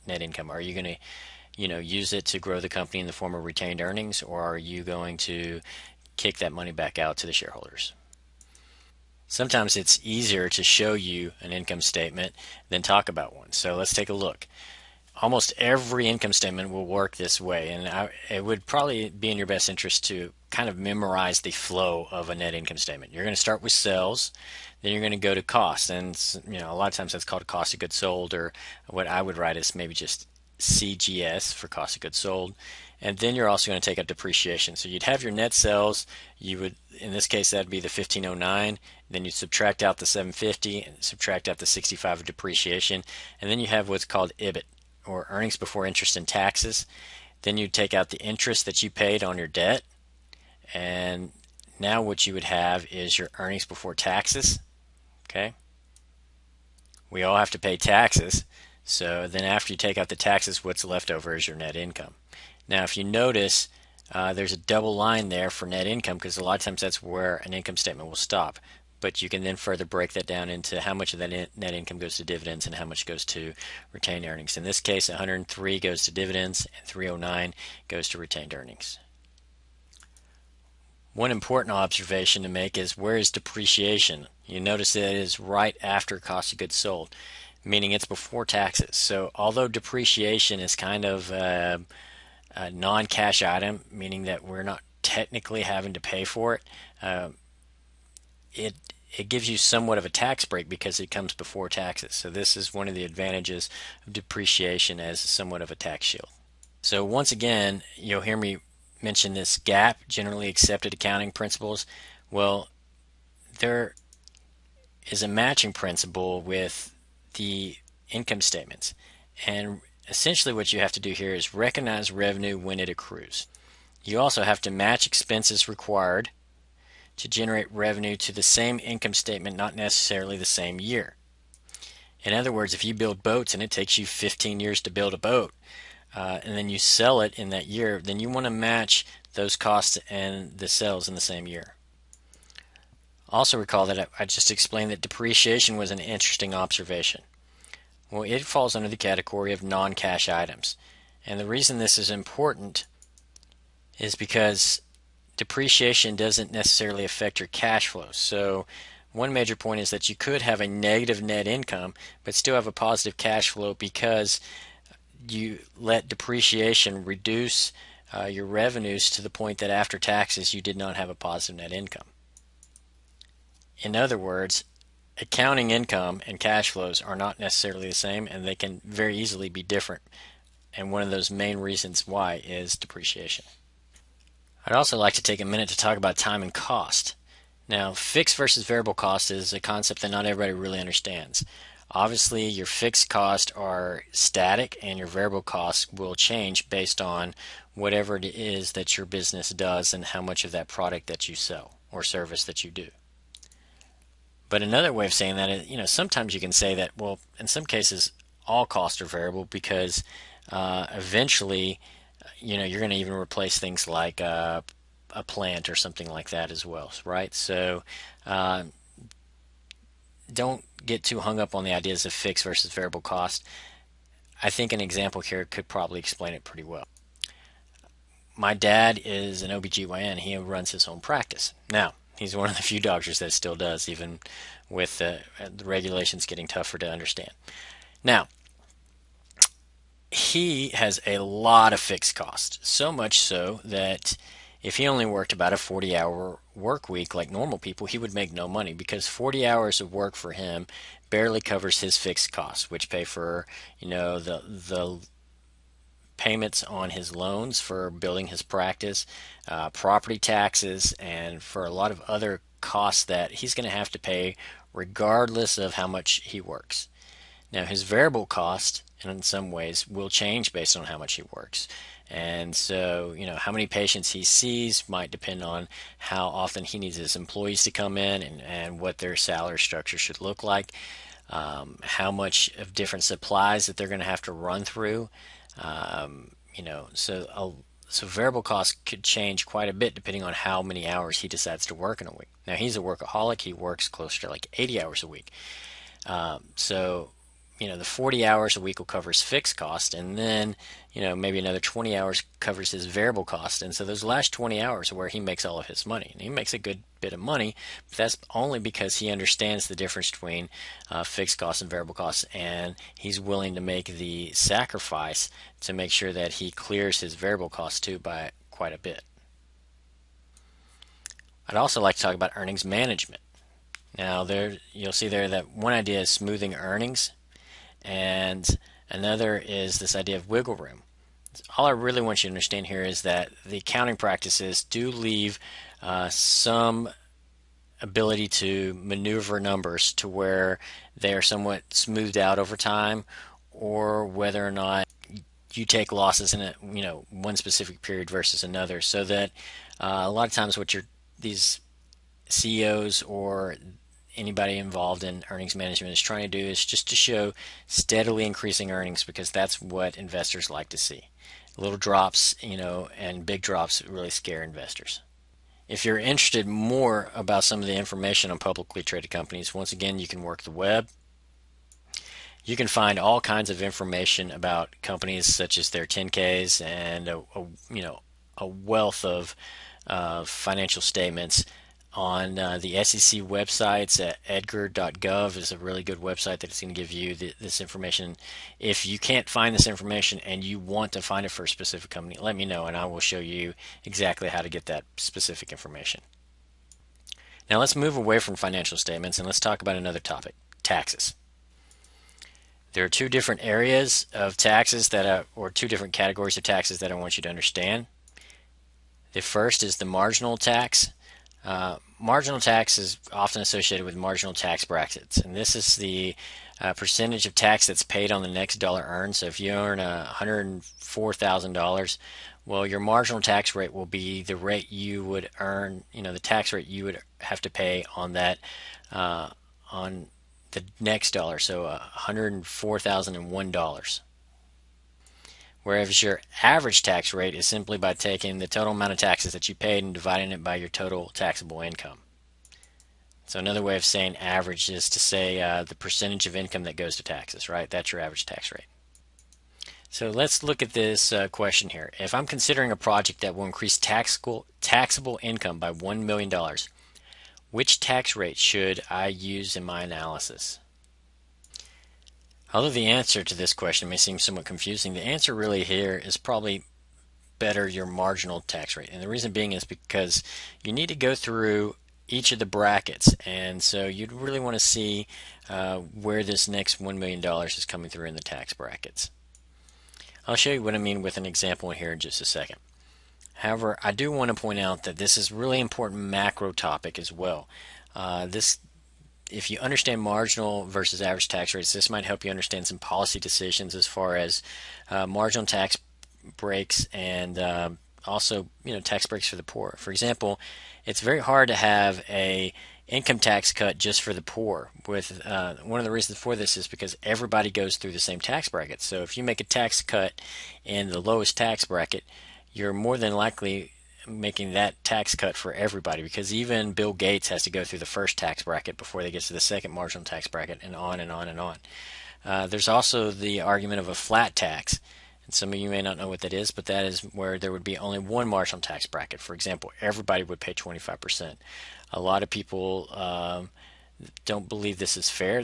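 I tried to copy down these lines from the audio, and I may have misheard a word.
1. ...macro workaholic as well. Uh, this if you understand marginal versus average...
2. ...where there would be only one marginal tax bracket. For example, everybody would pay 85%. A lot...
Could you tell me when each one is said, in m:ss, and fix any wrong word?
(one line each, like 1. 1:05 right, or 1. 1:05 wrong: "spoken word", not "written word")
1. 8:06 wrong: "topic", not "workaholic"
2. 8:47 wrong: "25", not "85".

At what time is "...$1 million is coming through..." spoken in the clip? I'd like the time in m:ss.
7:56.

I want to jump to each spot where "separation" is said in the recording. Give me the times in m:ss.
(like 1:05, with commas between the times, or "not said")
not said.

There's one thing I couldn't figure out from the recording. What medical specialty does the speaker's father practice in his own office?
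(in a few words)
OBGYN.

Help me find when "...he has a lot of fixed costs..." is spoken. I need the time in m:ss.
4:00.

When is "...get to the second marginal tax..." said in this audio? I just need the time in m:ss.
8:39.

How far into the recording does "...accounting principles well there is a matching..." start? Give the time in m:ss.
1:50.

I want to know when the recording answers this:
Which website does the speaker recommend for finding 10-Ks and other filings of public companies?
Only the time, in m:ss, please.
6:24.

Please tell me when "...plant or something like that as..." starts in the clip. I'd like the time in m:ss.
3:35.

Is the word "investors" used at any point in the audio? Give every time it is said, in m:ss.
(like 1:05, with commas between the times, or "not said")
5:59, 6:04.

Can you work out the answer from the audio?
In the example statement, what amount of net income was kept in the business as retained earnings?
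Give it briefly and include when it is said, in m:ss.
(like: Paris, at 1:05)
309, at 1:16.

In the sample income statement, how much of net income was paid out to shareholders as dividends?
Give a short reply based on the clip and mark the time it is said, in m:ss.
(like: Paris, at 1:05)
103, at 1:15.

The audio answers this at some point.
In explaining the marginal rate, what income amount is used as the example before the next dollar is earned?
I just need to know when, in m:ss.
7:00.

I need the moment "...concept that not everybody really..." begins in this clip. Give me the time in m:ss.
3:09.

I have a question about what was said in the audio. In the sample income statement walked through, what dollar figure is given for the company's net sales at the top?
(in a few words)
1509.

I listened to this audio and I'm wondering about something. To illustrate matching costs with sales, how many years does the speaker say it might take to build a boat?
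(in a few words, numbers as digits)
15.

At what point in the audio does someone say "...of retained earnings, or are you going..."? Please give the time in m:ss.
0:03.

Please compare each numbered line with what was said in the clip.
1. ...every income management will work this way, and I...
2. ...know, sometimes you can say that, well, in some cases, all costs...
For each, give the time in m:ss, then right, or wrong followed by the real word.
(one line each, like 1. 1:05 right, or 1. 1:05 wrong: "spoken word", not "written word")
1. 0:15 wrong: "statement", not "management"
2. 3:25 right.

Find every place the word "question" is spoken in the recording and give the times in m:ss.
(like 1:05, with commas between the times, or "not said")
7:31, 7:43.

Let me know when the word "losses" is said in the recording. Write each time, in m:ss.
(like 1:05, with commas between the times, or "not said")
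5:45.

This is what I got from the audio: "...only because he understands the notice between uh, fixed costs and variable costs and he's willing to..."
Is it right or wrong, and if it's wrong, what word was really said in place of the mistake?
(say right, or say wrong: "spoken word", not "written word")
wrong: "difference", not "notice".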